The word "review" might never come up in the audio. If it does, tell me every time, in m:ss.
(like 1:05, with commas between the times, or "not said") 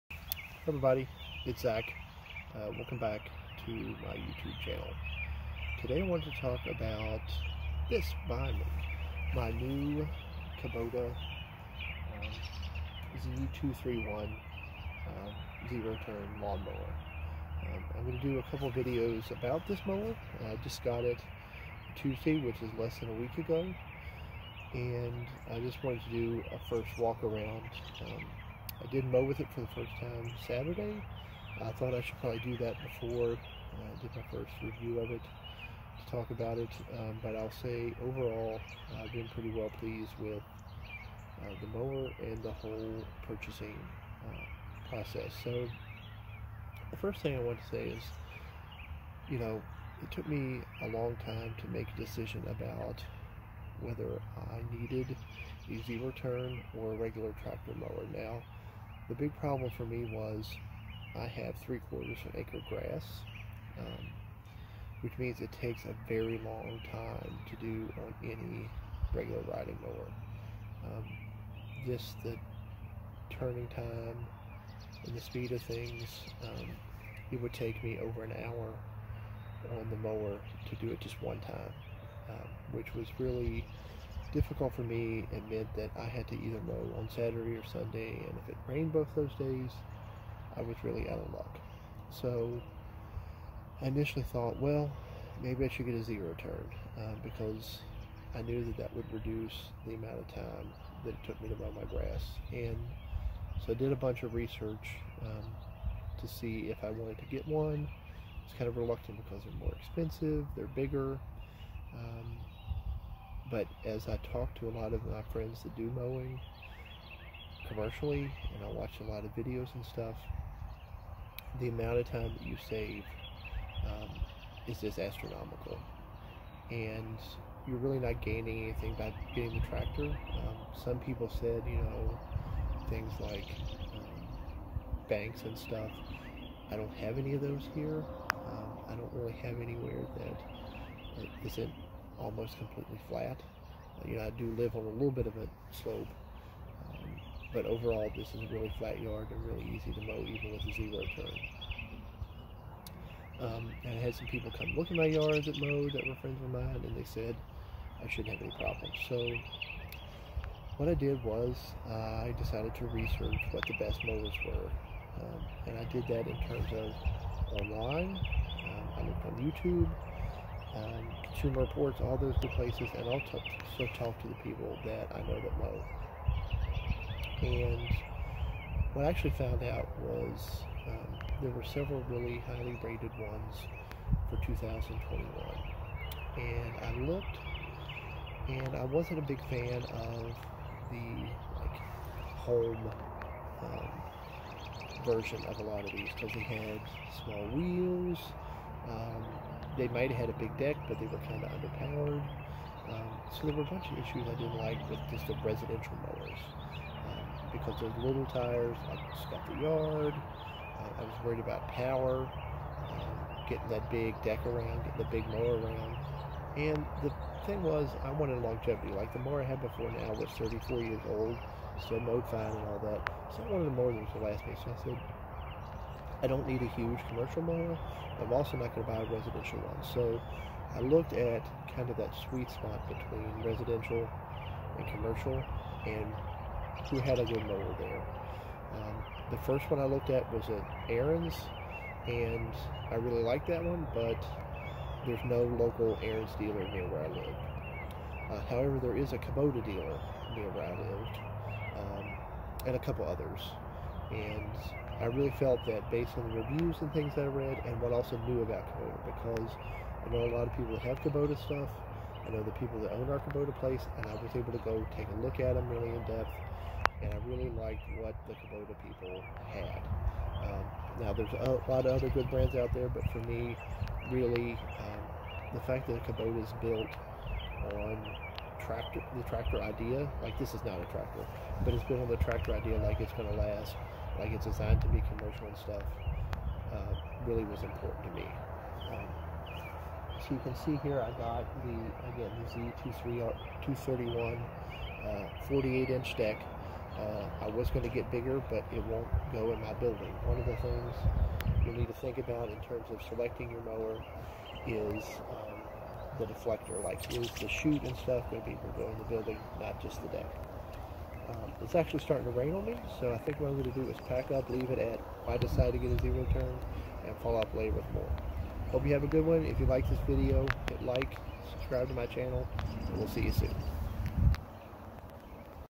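0:34, 4:16.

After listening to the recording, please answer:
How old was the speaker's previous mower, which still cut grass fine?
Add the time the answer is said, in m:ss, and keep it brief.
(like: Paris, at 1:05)
34 years, at 3:40.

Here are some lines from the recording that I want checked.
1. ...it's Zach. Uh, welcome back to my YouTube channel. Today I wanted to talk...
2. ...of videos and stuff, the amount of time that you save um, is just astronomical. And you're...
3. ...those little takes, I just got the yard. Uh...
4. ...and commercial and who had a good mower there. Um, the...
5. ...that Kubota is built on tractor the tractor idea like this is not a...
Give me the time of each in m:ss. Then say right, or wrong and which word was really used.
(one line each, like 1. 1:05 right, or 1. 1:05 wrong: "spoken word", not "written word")
1. 0:01 right
2. 1:59 right
3. 3:27 wrong: "tires", not "takes"
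4. 3:54 right
5. 4:35 right.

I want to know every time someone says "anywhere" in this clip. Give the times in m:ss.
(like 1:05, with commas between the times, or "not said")
2:19.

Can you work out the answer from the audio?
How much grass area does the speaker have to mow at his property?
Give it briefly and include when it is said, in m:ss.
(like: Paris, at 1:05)
three quarters of an acre, at 1:01.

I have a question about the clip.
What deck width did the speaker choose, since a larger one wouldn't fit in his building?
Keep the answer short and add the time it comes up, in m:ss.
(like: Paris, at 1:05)
48 inch, at 4:55.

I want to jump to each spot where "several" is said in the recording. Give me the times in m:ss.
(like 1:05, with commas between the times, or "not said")
3:01.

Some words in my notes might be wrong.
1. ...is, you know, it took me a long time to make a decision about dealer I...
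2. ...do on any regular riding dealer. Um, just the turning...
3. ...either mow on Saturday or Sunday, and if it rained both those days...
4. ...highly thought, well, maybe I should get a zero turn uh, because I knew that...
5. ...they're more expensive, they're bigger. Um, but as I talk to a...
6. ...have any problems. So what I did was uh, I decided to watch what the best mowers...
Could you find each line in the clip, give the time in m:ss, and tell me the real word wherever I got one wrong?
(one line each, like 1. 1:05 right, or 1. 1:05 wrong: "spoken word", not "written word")
1. 0:47 wrong: "whether", not "dealer"
2. 1:07 wrong: "mower", not "dealer"
3. 1:26 right
4. 1:33 wrong: "initially", not "highly"
5. 1:49 right
6. 2:38 wrong: "research", not "watch".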